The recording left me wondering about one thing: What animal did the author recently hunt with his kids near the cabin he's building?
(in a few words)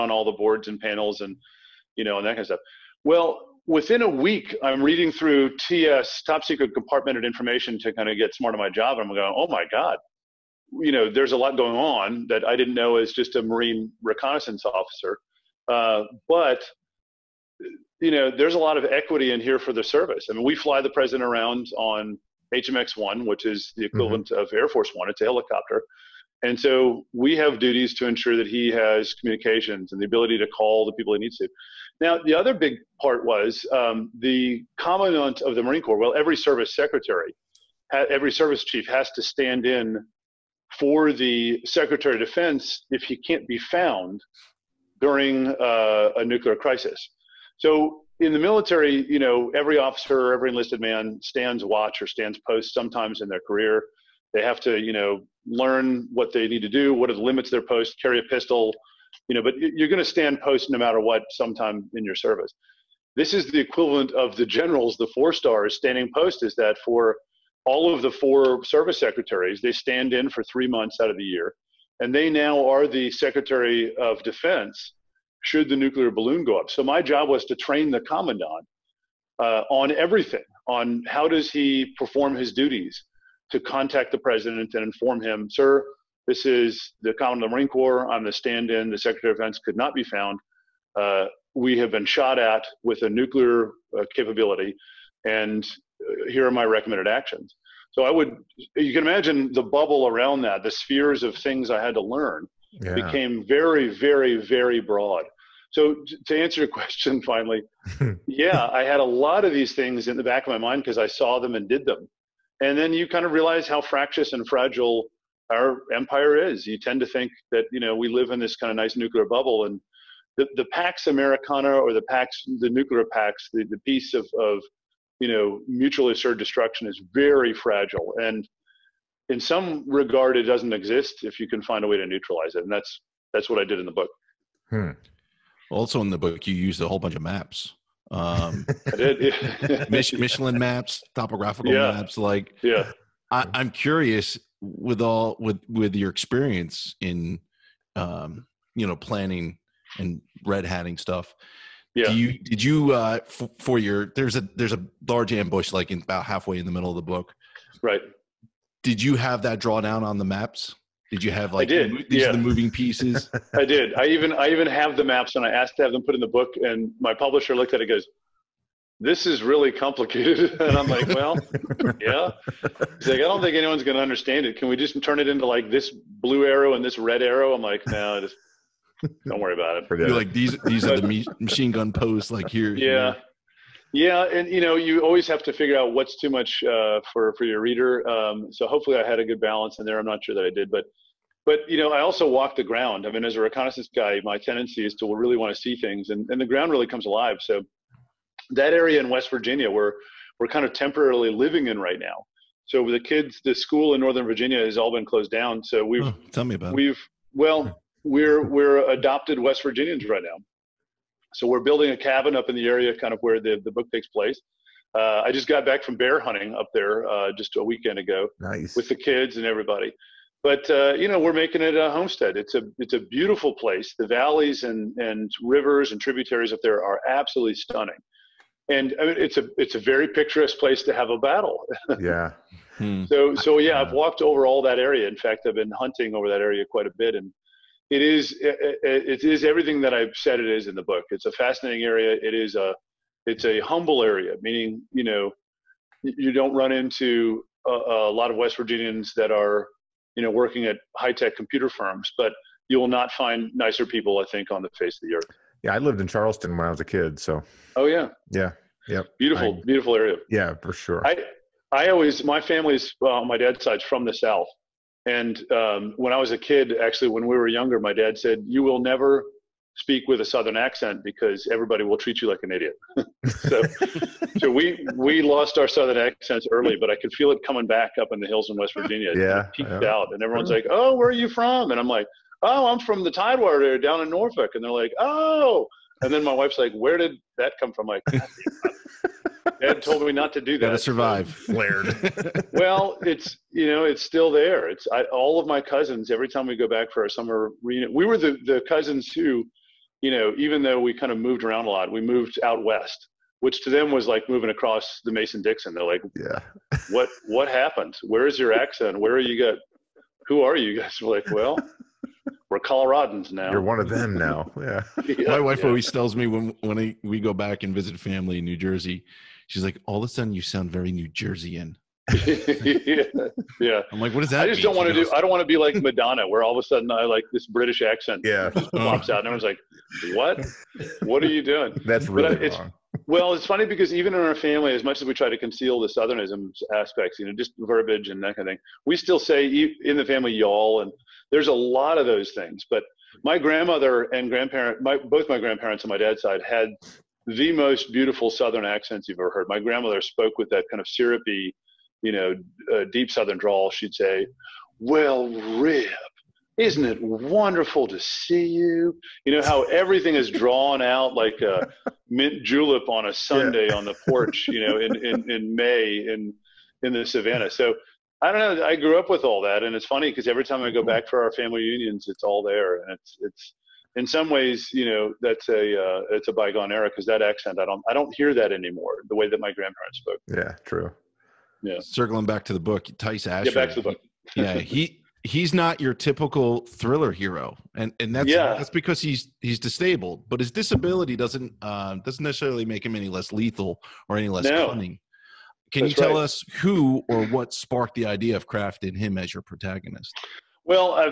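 Bear.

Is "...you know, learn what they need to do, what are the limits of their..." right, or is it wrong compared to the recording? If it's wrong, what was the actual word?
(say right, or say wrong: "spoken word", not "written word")
right.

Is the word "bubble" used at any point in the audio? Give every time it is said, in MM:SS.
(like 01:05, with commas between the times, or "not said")
01:39, 01:59.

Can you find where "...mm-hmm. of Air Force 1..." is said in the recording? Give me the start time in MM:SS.
00:24.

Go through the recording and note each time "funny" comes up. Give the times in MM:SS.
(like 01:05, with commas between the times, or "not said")
05:33, 06:09.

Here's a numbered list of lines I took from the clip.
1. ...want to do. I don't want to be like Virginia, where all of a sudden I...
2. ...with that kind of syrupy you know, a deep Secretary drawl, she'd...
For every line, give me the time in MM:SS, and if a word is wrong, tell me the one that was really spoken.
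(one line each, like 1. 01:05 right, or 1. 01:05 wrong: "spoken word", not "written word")
1. 05:24 wrong: "Madonna", not "Virginia"
2. 05:50 wrong: "Southern", not "Secretary".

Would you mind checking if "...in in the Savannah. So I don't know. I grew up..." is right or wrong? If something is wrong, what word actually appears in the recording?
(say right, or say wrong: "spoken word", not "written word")
right.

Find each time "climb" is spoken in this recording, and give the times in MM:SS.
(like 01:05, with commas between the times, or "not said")
not said.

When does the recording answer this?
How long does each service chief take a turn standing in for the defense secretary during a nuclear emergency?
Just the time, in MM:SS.
01:10.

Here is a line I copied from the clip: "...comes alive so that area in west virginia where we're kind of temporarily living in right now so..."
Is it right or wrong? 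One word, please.
right.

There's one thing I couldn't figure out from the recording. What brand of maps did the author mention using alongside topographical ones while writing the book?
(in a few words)
Michelin.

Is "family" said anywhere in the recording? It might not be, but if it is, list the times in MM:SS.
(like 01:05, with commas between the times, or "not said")
04:22, 05:17, 05:34, 05:40, 06:11.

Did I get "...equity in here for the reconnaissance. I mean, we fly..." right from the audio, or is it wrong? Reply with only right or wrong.
wrong.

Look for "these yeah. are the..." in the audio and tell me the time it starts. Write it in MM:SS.
02:42.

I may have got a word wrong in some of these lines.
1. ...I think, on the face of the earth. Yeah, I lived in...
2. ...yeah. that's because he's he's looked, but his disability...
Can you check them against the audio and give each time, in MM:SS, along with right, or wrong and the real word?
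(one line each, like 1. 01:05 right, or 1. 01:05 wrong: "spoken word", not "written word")
1. 04:14 right
2. 06:28 wrong: "disabled", not "looked".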